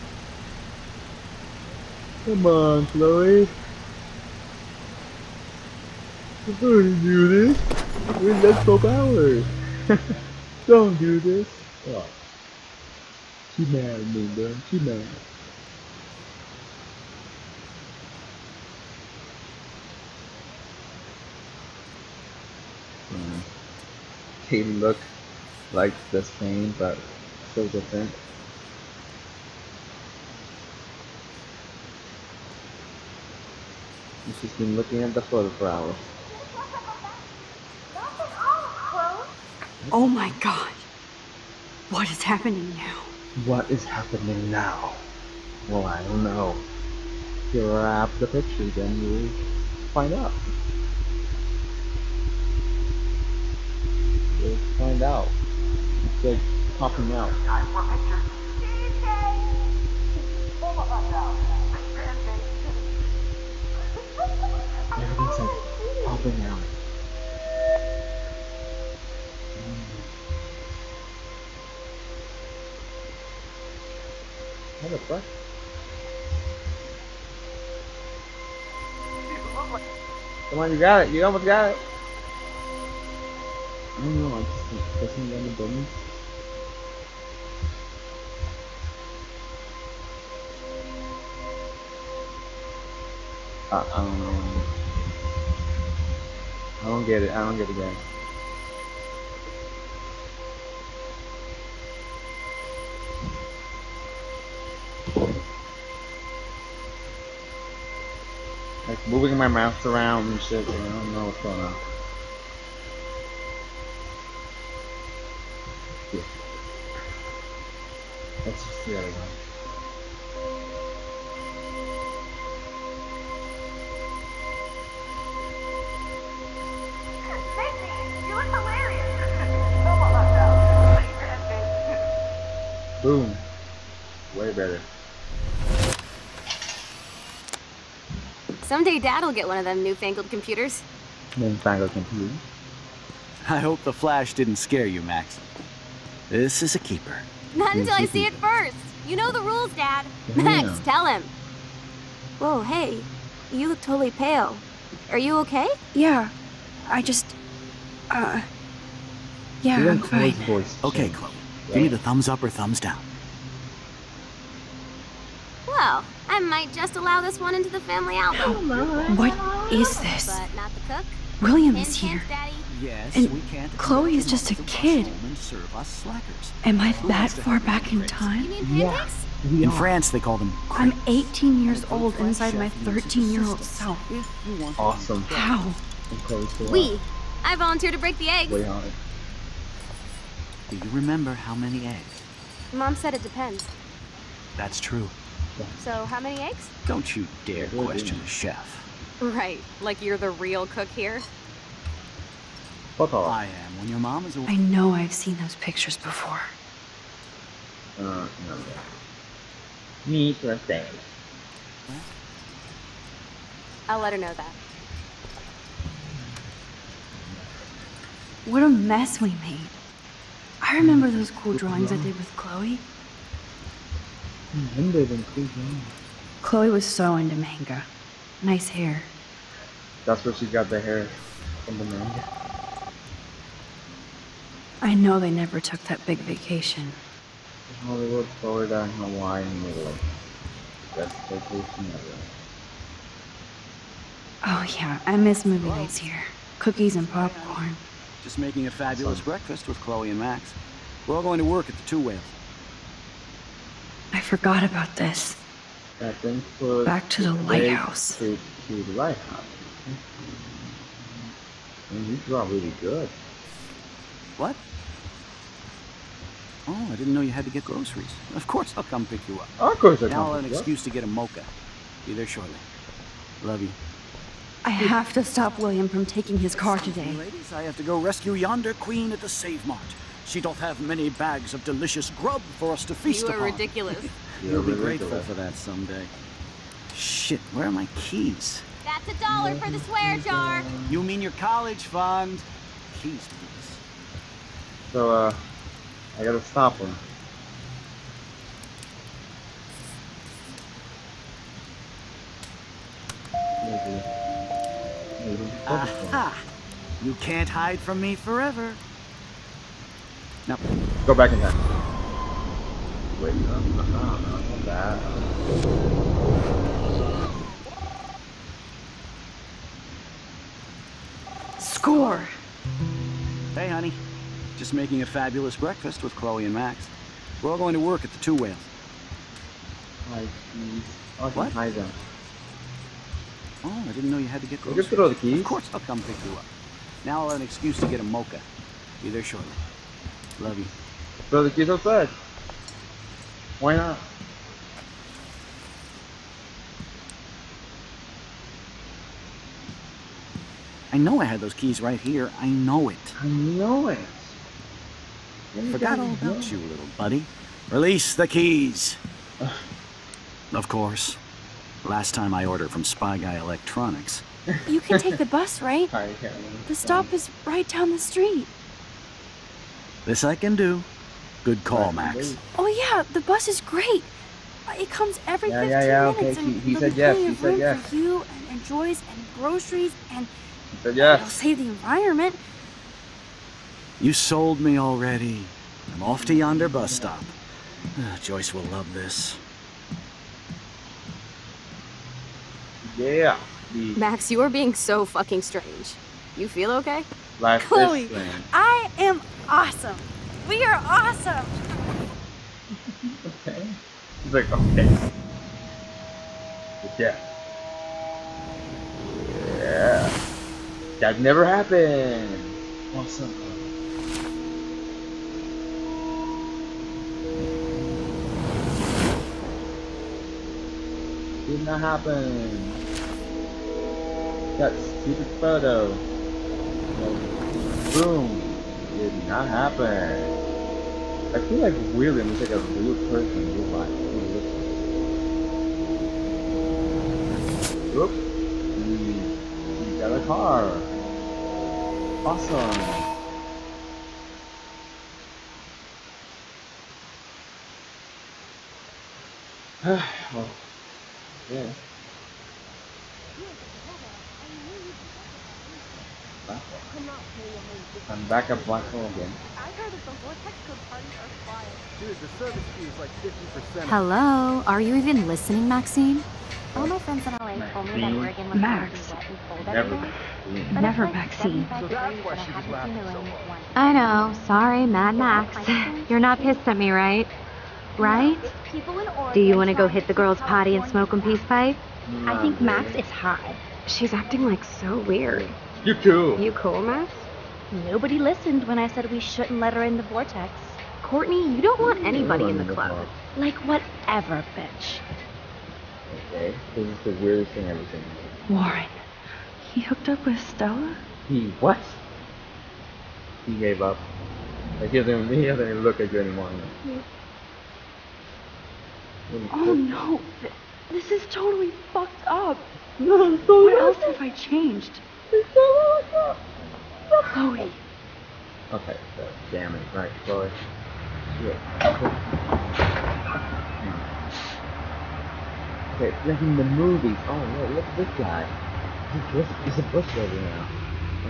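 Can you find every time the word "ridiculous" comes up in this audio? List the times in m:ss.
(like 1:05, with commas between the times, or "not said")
4:43.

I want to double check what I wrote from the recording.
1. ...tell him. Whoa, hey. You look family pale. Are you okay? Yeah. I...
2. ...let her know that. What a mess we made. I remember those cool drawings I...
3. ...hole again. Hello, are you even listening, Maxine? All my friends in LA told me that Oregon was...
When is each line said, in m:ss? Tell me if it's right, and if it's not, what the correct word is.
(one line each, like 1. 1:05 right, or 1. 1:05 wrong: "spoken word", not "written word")
1. 2:30 wrong: "totally", not "family"
2. 3:34 right
3. 7:38 right.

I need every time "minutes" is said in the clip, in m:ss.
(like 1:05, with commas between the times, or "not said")
6:16.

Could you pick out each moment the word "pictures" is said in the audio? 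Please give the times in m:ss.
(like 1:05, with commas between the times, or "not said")
0:48, 0:57, 3:25.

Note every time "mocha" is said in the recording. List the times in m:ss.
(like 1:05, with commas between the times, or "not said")
4:31, 5:38.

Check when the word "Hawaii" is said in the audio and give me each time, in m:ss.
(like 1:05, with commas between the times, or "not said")
3:58.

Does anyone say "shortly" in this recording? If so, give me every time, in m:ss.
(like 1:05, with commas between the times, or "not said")
4:32, 5:39.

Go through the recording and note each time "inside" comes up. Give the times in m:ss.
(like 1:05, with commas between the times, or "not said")
3:02.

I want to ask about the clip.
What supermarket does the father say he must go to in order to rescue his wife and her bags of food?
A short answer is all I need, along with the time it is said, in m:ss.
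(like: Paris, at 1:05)
Save Mart, at 4:39.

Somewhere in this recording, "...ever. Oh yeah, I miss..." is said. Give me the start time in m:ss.
4:01.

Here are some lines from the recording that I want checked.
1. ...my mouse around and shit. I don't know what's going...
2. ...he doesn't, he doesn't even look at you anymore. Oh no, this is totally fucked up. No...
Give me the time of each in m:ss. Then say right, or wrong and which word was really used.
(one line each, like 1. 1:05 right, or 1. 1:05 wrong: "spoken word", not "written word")
1. 1:49 right
2. 8:24 right.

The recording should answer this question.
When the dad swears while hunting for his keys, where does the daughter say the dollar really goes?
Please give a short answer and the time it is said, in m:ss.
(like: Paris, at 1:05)
College fund, at 4:51.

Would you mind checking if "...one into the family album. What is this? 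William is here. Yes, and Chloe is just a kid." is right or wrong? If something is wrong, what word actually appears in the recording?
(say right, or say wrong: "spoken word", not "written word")
right.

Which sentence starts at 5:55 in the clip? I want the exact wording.
Forgot all about you, little buddy.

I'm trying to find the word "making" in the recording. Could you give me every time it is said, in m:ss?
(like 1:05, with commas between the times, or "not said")
4:08, 5:24.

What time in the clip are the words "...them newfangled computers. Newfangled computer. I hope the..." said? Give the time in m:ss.
2:19.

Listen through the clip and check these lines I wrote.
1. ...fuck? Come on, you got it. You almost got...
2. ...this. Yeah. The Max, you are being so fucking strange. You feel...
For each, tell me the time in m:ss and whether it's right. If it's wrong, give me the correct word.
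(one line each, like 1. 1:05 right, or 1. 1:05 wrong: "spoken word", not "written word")
1. 1:14 right
2. 6:28 right.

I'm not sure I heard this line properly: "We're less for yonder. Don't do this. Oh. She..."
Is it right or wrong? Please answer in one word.
wrong.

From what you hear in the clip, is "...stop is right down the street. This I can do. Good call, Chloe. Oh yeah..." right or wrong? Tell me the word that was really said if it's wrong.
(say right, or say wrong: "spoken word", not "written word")
wrong: "Max", not "Chloe".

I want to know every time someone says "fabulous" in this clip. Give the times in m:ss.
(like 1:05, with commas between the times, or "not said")
4:08, 5:25.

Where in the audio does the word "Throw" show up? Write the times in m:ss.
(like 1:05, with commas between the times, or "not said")
5:41.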